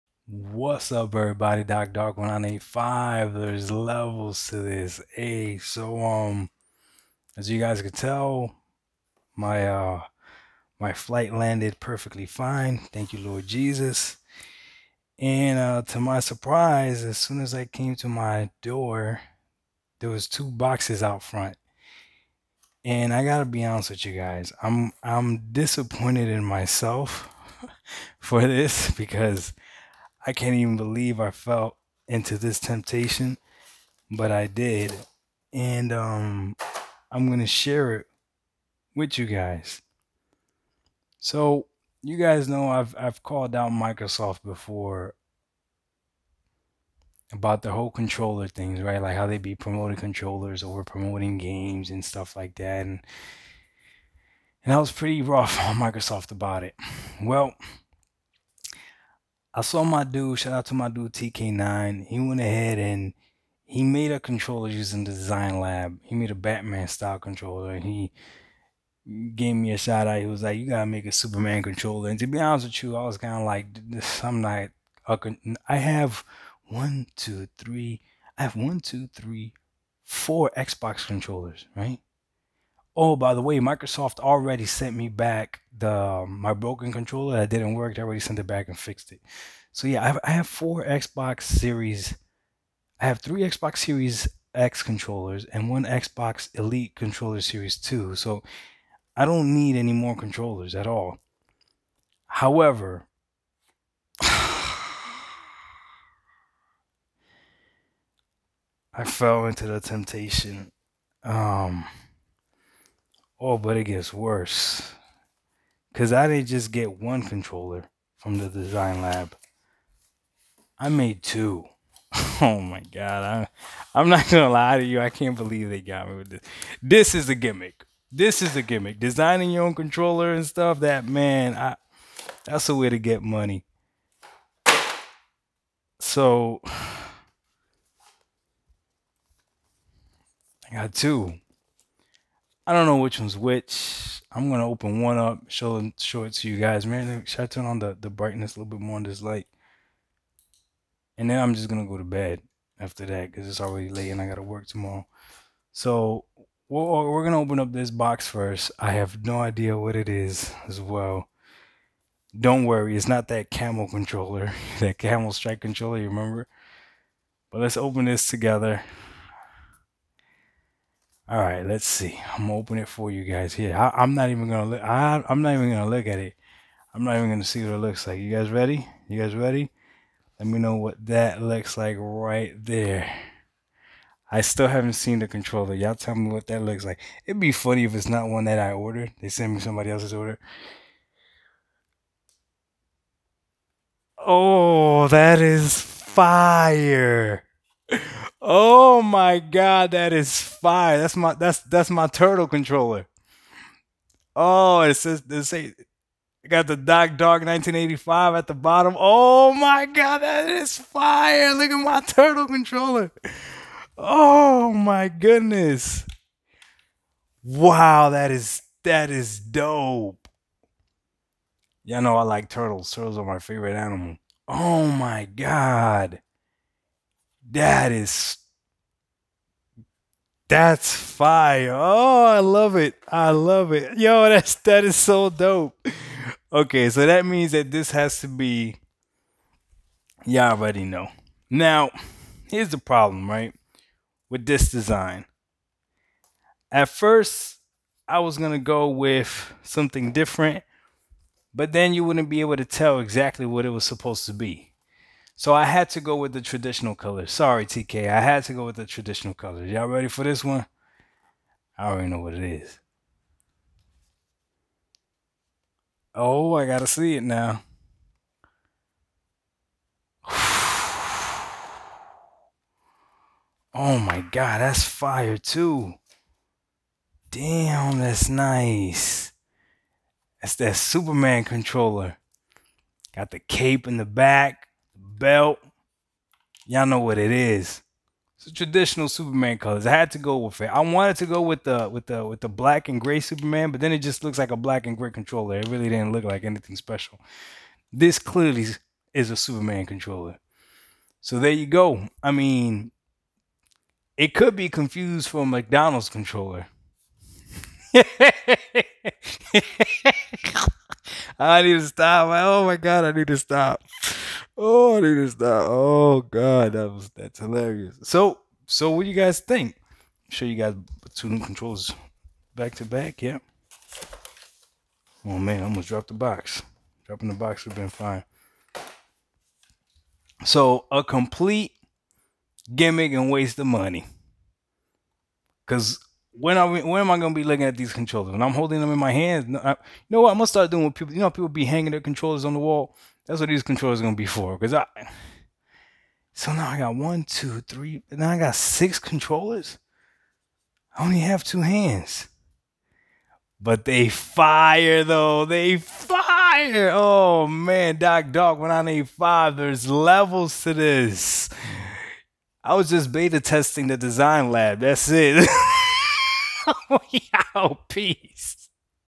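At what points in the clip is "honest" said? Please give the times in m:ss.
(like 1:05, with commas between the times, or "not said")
0:23, 1:12.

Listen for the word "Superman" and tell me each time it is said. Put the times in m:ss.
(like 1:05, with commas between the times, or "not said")
1:11, 4:40, 4:49, 4:53, 4:59.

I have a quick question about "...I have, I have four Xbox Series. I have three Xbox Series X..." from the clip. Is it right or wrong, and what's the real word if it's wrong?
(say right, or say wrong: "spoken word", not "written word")
right.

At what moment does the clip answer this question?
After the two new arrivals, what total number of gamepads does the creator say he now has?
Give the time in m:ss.
5:48.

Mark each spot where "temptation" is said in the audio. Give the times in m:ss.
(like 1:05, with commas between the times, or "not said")
0:32, 1:49.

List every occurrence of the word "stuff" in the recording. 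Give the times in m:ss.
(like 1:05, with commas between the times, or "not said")
0:52, 2:10.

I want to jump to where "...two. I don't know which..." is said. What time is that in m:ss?
2:20.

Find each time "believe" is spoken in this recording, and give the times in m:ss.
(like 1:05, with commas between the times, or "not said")
0:30, 2:05.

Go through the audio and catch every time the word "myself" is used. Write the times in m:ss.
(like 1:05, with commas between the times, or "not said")
0:26.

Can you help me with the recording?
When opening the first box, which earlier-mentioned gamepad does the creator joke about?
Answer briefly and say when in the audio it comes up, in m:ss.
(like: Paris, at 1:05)
Camel controller, at 2:43.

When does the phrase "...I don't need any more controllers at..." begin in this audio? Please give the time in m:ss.
1:39.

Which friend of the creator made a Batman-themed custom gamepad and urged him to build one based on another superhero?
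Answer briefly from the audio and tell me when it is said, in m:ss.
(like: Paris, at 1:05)
TK9, at 1:01.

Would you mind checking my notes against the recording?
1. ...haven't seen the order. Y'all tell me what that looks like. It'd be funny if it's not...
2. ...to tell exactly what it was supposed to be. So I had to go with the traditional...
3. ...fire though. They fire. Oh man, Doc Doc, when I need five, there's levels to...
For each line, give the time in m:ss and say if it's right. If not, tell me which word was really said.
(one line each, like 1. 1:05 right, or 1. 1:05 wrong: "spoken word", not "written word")
1. 3:04 wrong: "controller", not "order"
2. 4:12 right
3. 5:54 right.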